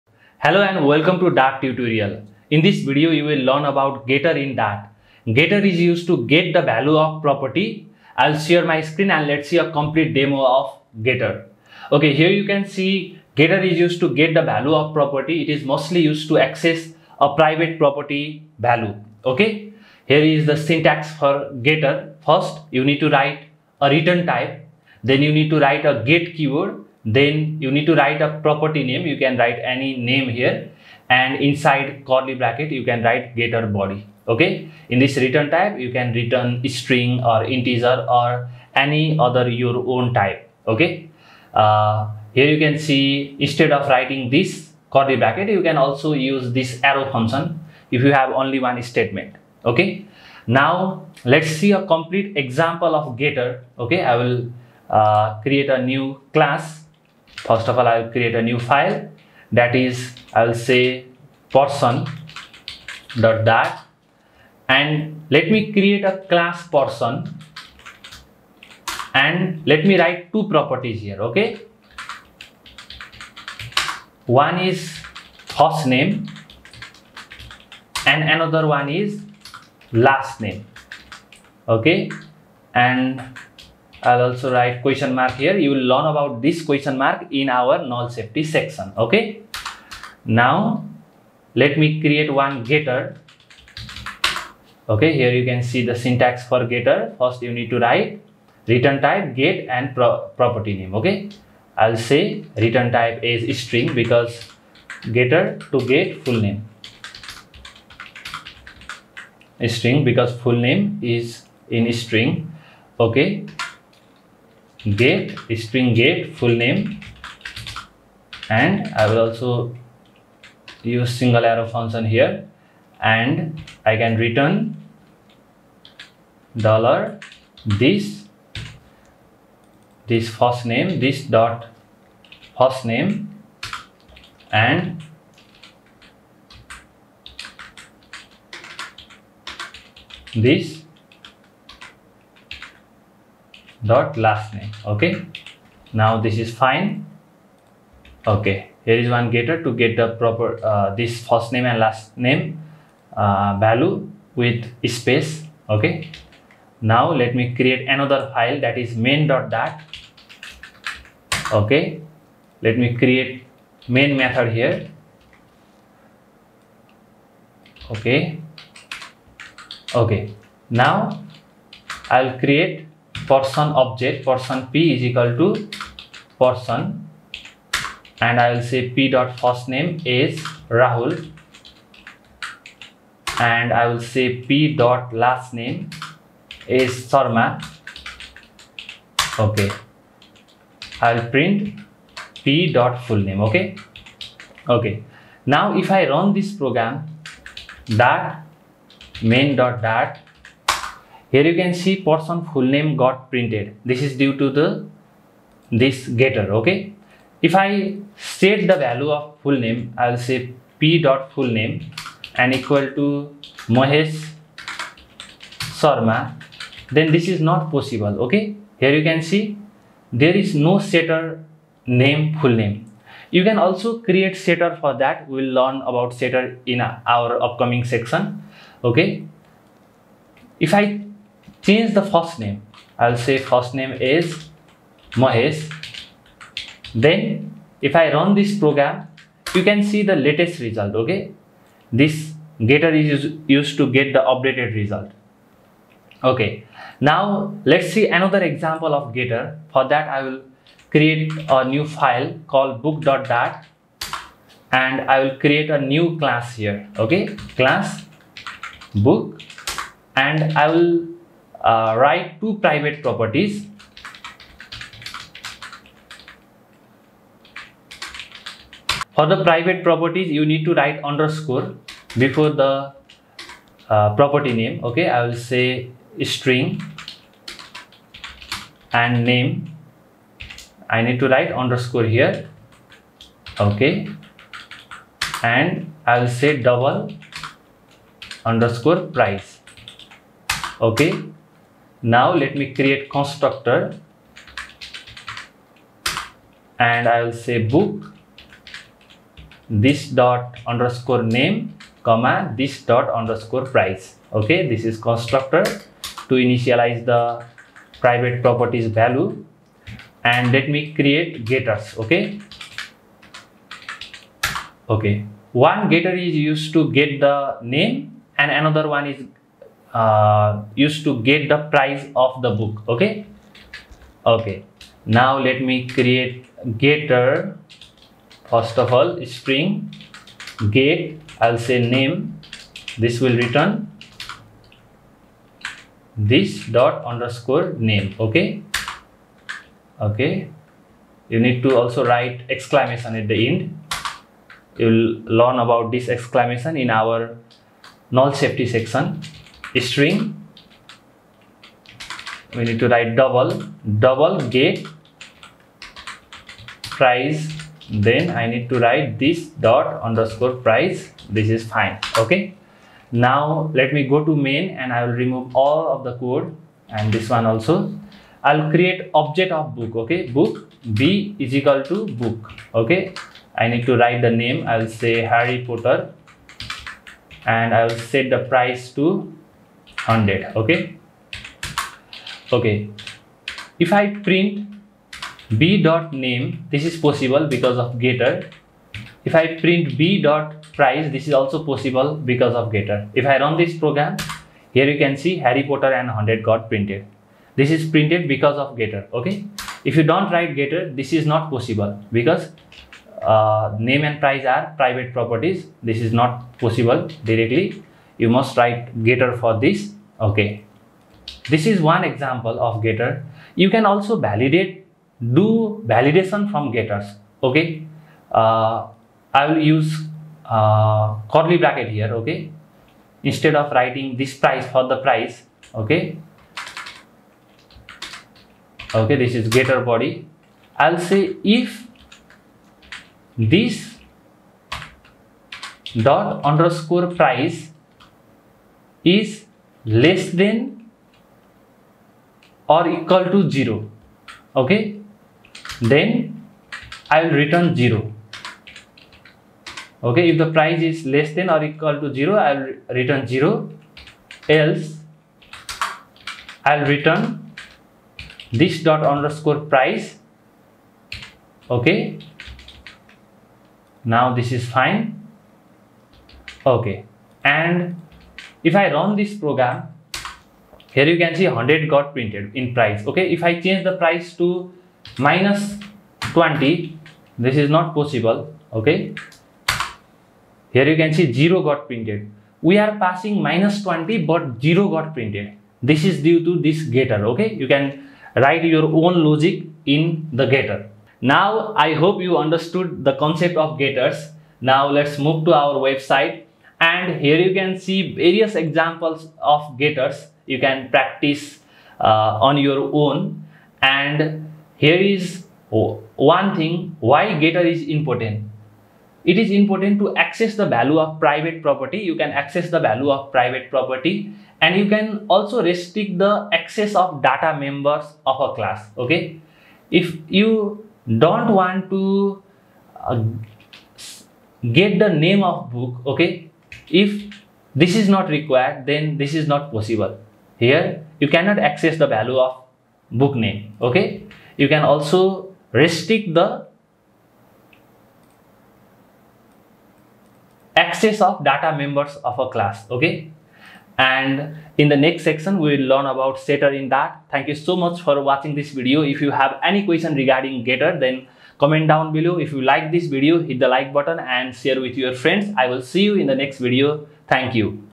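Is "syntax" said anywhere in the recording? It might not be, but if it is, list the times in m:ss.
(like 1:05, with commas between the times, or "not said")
0:20, 1:35.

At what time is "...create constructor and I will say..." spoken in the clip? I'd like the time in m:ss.
4:52.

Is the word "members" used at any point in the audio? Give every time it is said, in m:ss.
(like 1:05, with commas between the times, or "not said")
8:37, 9:01.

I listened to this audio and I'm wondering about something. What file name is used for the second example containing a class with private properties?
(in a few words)
book.dart.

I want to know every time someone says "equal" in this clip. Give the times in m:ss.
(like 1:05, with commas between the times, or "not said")
2:55, 3:32, 6:11, 7:22, 7:31.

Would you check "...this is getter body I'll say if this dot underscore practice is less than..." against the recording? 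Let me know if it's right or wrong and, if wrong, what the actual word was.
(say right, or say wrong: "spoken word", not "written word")
wrong: "price", not "practice".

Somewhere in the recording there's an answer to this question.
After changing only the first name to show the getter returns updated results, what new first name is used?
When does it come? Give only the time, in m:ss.
3:55.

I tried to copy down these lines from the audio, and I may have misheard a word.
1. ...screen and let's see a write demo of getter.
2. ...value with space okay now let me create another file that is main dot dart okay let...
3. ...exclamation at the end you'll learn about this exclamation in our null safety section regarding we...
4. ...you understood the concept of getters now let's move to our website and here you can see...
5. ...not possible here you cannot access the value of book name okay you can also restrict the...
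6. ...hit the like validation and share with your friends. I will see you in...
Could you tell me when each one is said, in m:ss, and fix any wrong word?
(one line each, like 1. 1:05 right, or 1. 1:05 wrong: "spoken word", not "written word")
1. 0:08 wrong: "complete", not "write"
2. 2:33 right
3. 5:42 wrong: "string", not "regarding"
4. 8:12 right
5. 8:49 right
6. 9:13 wrong: "button", not "validation".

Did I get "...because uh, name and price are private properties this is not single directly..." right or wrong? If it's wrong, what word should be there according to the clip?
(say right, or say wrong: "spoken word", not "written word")
wrong: "possible", not "single".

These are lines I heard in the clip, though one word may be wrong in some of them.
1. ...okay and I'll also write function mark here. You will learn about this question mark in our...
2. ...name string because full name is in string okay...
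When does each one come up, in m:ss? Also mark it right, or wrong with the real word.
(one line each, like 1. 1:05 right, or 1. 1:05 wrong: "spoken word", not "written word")
1. 1:21 wrong: "question", not "function"
2. 1:46 right.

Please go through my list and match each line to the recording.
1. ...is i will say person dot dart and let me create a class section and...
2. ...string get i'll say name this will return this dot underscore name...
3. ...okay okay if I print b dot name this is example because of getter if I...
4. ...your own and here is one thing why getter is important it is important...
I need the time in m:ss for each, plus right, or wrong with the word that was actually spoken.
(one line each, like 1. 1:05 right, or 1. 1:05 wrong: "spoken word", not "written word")
1. 0:59 wrong: "person", not "section"
2. 5:29 right
3. 6:20 wrong: "possible", not "example"
4. 8:22 right.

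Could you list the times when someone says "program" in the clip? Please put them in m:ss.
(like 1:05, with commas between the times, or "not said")
3:16, 3:58, 6:33, 7:49.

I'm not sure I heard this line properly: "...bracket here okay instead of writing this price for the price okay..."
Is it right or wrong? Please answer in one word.
right.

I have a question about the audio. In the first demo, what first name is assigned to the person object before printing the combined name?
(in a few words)
Rahul.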